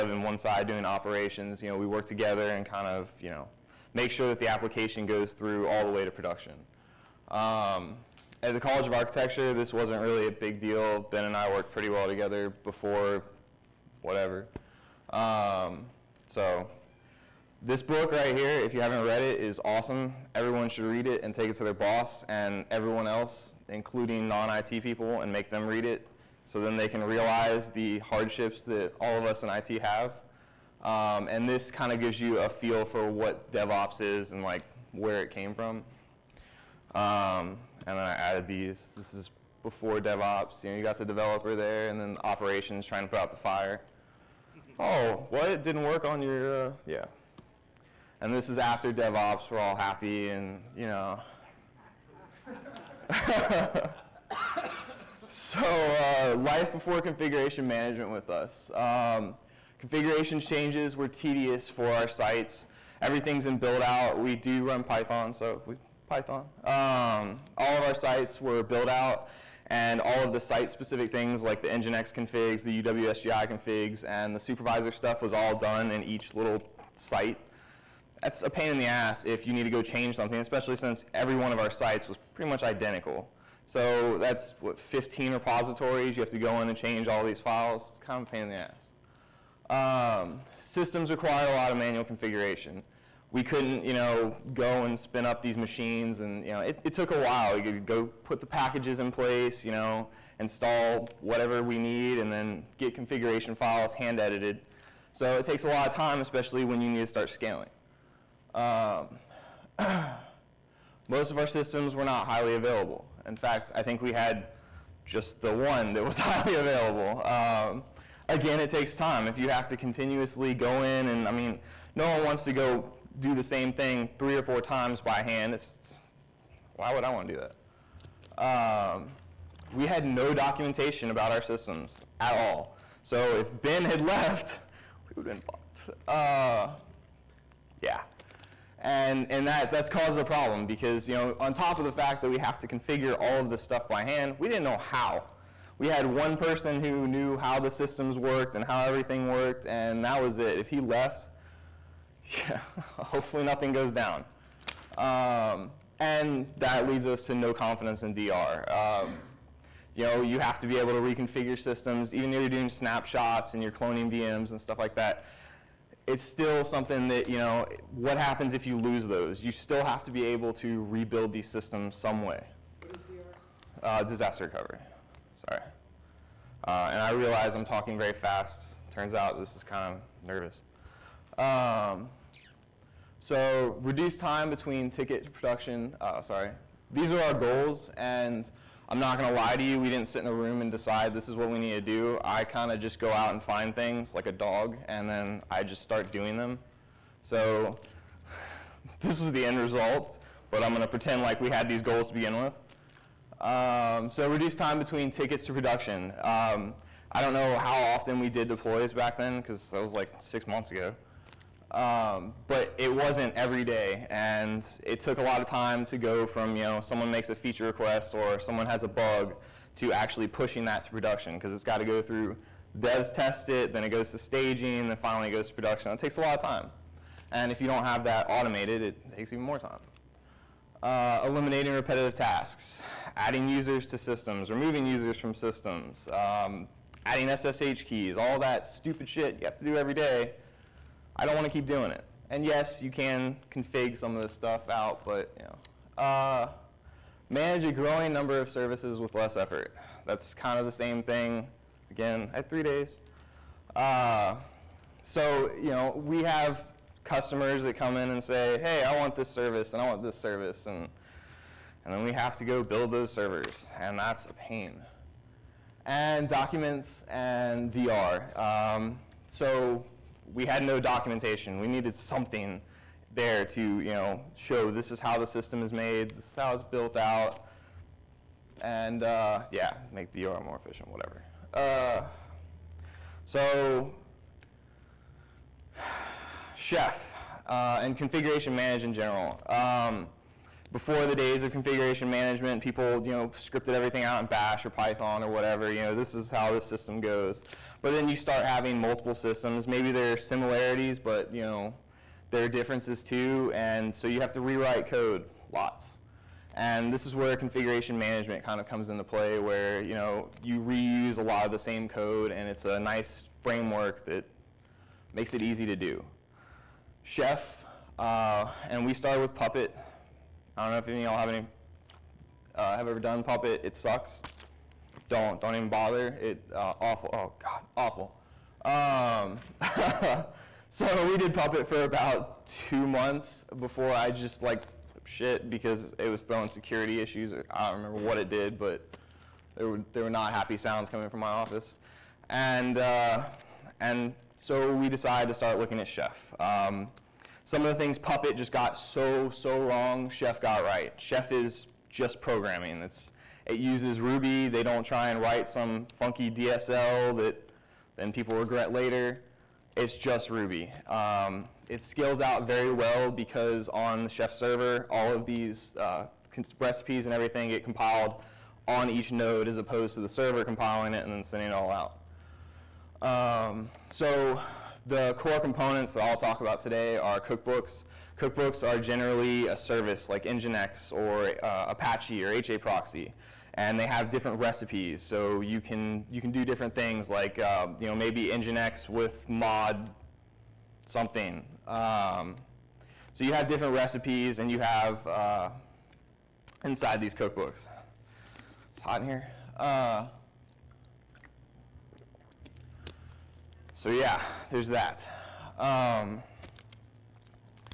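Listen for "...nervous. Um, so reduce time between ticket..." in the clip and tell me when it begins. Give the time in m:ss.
3:00.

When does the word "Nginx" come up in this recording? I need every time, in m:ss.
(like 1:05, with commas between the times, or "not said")
1:11, 6:20, 6:28.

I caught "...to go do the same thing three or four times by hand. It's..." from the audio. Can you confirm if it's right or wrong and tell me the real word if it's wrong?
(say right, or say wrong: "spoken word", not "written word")
right.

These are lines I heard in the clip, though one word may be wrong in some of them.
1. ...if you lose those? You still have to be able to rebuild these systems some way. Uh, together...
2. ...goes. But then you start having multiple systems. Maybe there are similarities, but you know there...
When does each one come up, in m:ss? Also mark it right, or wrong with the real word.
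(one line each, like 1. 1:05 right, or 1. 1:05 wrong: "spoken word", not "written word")
1. 2:48 wrong: "disaster", not "together"
2. 4:56 right.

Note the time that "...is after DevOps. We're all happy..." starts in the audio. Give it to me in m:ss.
0:48.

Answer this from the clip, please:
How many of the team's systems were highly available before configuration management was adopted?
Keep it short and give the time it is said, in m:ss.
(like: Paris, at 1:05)
1, at 1:55.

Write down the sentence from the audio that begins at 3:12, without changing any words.
I kinda just go out and find things like a dog, and then I just start doing them.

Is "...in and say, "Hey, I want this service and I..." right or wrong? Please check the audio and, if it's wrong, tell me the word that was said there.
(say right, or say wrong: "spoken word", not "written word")
right.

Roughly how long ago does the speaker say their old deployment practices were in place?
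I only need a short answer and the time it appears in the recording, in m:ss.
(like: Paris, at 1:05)
six months ago, at 3:30.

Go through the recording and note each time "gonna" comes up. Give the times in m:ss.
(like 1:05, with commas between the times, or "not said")
3:09, 3:20.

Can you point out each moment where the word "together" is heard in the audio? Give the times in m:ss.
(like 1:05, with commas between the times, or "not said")
0:02, 0:12.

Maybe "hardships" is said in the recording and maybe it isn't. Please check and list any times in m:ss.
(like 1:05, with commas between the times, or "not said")
0:27.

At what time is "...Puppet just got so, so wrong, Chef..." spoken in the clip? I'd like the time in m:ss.
5:47.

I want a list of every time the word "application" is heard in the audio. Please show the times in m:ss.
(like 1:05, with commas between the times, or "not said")
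0:04.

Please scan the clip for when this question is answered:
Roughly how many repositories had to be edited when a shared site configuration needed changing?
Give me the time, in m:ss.
1:24.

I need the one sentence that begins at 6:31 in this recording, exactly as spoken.
Um, so you have different recipes, and you have uh, inside these cookbooks.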